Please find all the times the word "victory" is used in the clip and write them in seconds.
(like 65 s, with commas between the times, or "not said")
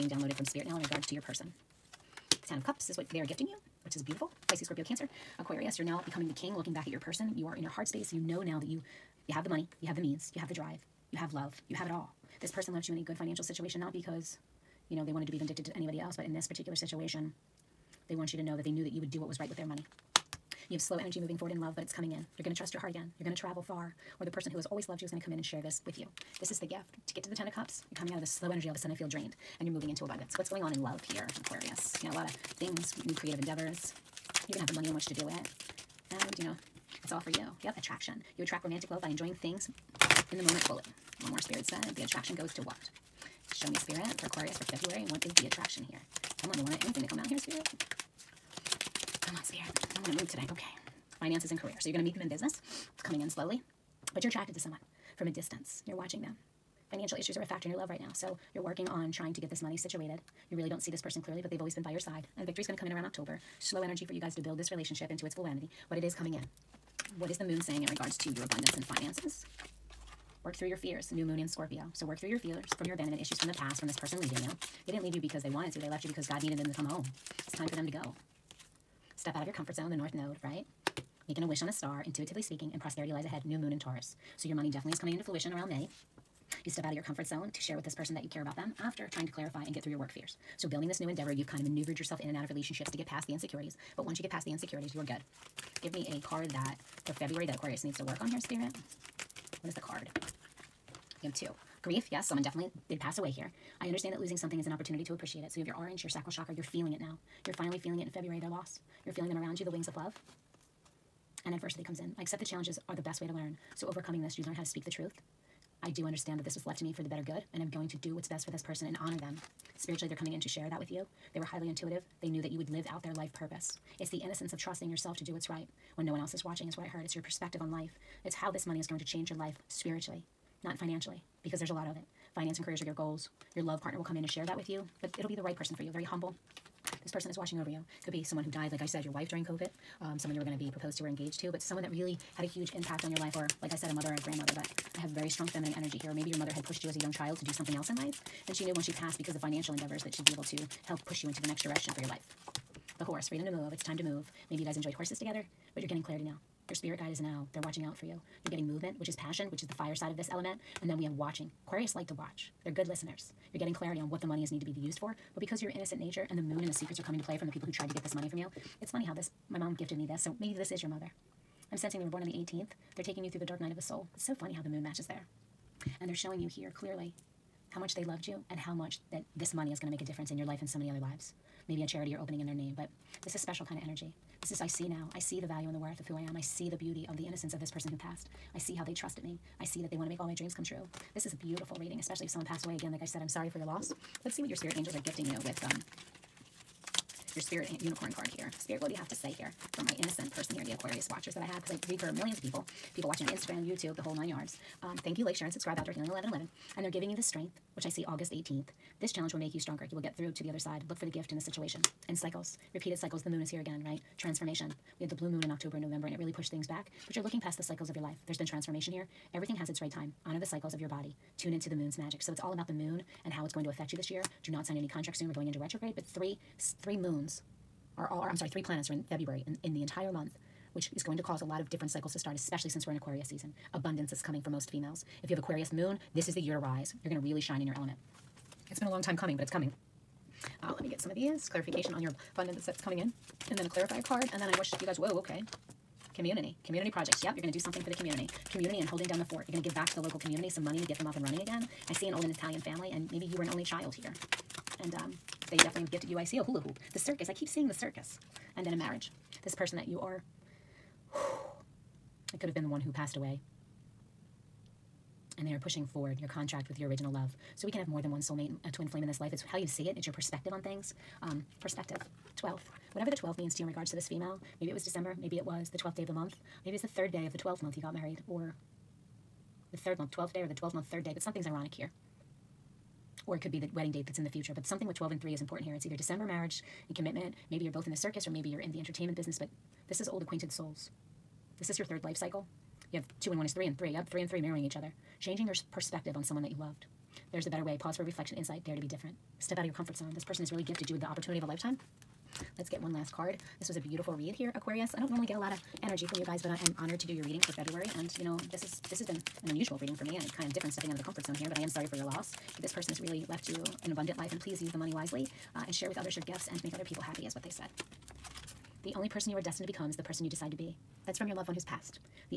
62 s.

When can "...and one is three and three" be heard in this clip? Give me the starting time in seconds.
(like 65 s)
293 s.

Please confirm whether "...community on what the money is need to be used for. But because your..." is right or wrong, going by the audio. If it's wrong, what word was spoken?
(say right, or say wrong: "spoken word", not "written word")
wrong: "clarity", not "community".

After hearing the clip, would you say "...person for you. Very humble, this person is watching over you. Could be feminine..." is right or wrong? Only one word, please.
wrong.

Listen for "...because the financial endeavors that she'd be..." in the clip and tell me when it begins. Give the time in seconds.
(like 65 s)
149 s.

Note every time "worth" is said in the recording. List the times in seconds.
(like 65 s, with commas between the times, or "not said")
185 s.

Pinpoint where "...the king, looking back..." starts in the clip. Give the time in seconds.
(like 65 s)
6 s.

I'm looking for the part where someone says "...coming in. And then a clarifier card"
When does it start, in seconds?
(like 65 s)
242 s.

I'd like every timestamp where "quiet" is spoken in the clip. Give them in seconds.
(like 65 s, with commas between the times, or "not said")
not said.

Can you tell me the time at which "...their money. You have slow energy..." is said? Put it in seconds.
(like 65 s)
19 s.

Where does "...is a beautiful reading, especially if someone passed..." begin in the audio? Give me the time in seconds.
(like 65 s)
191 s.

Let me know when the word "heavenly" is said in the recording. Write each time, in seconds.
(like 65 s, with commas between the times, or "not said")
not said.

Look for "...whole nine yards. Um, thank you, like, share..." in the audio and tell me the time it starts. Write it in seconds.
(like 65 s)
204 s.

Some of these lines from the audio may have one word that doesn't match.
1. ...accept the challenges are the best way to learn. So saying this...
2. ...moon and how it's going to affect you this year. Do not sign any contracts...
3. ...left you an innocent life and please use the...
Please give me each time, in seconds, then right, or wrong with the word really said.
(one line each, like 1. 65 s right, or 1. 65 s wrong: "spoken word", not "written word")
1. 112 s wrong: "overcoming", not "saying"
2. 222 s right
3. 313 s wrong: "abundant", not "innocent".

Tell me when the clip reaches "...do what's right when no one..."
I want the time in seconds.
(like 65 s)
125 s.